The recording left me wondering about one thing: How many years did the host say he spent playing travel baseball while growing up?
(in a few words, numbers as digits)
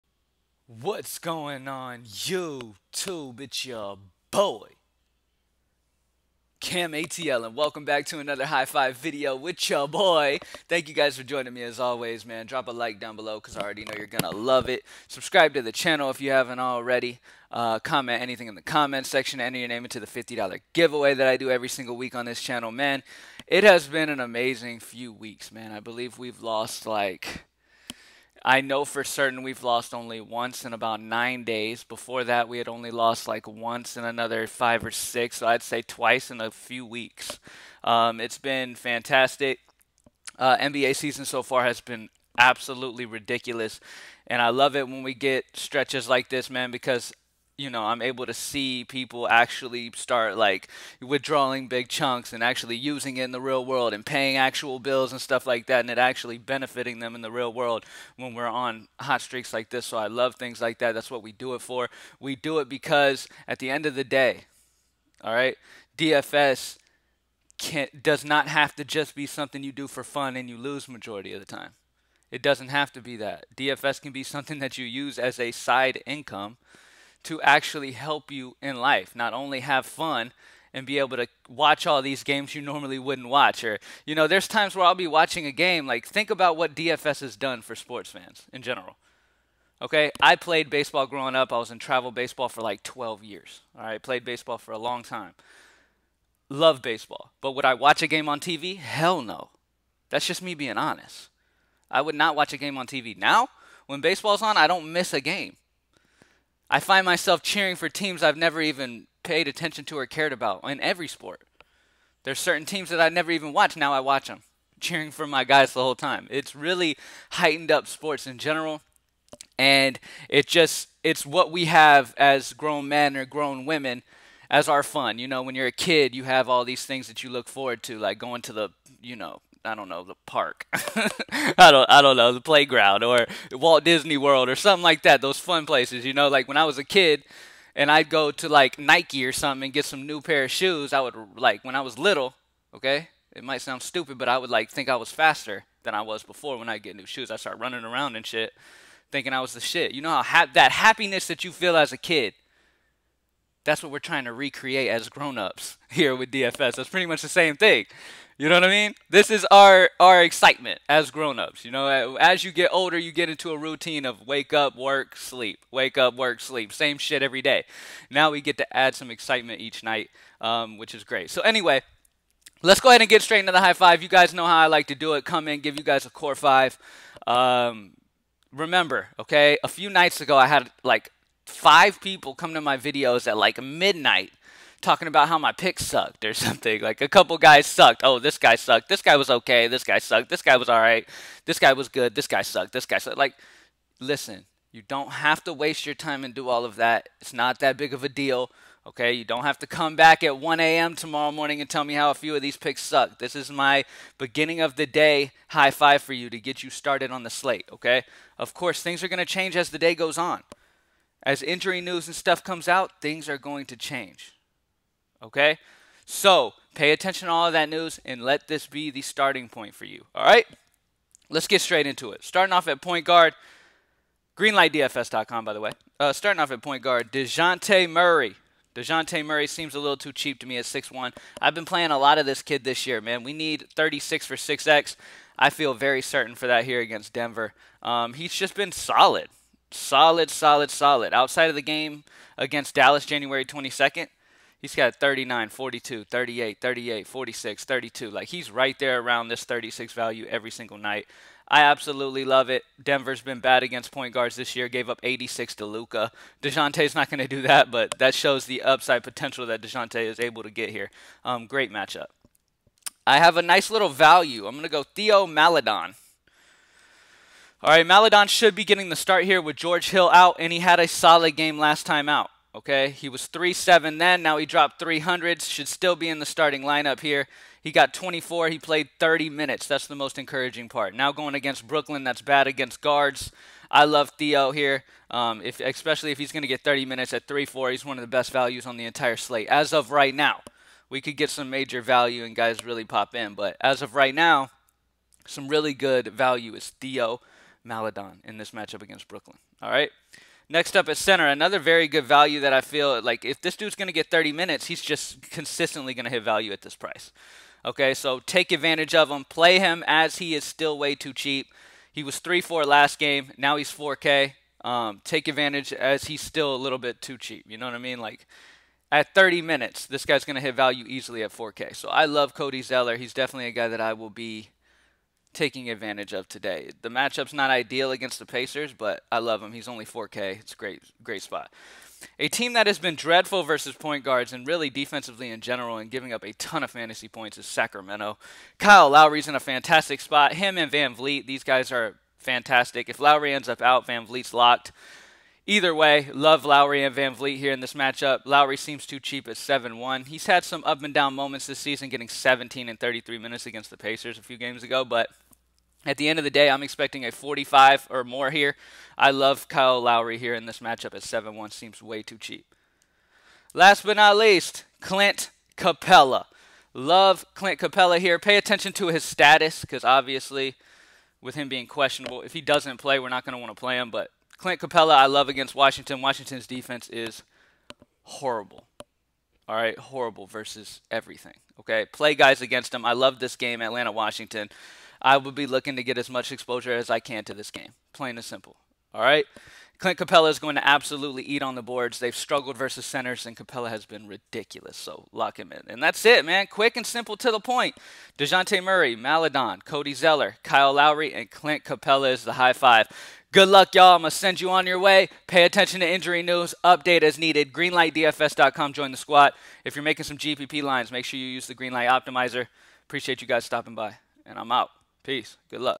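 12.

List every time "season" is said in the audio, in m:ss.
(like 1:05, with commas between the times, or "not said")
0:40, 5:51.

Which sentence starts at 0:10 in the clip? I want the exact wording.
Thank you guys for joining me as always, man.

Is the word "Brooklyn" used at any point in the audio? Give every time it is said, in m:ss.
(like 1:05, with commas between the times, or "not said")
4:41, 4:59.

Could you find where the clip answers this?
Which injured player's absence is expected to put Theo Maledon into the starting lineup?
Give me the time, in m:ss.
4:29.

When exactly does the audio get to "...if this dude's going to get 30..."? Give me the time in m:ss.
5:03.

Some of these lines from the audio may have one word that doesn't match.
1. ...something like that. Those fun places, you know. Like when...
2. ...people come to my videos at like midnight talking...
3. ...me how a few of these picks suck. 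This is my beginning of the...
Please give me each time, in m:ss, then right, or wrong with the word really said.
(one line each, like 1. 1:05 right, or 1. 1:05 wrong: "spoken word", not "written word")
1. 2:14 right
2. 3:02 right
3. 3:21 right.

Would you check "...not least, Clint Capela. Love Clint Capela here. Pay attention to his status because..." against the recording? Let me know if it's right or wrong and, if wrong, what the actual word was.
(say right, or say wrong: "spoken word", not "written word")
right.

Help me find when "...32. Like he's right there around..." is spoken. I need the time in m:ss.
4:07.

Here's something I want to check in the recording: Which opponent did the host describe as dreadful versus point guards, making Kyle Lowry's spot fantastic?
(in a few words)
Sacramento.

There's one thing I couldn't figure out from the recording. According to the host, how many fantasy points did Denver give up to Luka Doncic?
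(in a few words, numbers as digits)
86.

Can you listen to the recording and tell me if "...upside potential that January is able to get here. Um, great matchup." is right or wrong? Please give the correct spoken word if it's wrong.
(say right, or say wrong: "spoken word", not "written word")
wrong: "Dejounte", not "January".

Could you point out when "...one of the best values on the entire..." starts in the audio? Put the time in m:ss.
4:47.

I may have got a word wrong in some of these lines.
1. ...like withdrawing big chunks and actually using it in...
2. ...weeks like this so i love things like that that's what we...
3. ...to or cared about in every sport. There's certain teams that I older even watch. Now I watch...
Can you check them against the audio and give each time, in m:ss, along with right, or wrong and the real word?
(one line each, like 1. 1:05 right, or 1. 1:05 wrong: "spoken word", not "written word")
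1. 0:50 right
2. 0:59 wrong: "streaks", not "weeks"
3. 1:49 wrong: "never", not "older".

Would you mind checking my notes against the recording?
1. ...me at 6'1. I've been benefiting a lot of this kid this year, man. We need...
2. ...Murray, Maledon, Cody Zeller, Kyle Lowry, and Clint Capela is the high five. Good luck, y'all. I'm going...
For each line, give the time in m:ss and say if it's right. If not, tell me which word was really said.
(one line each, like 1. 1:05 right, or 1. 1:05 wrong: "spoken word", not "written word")
1. 3:50 wrong: "playing", not "benefiting"
2. 6:38 right.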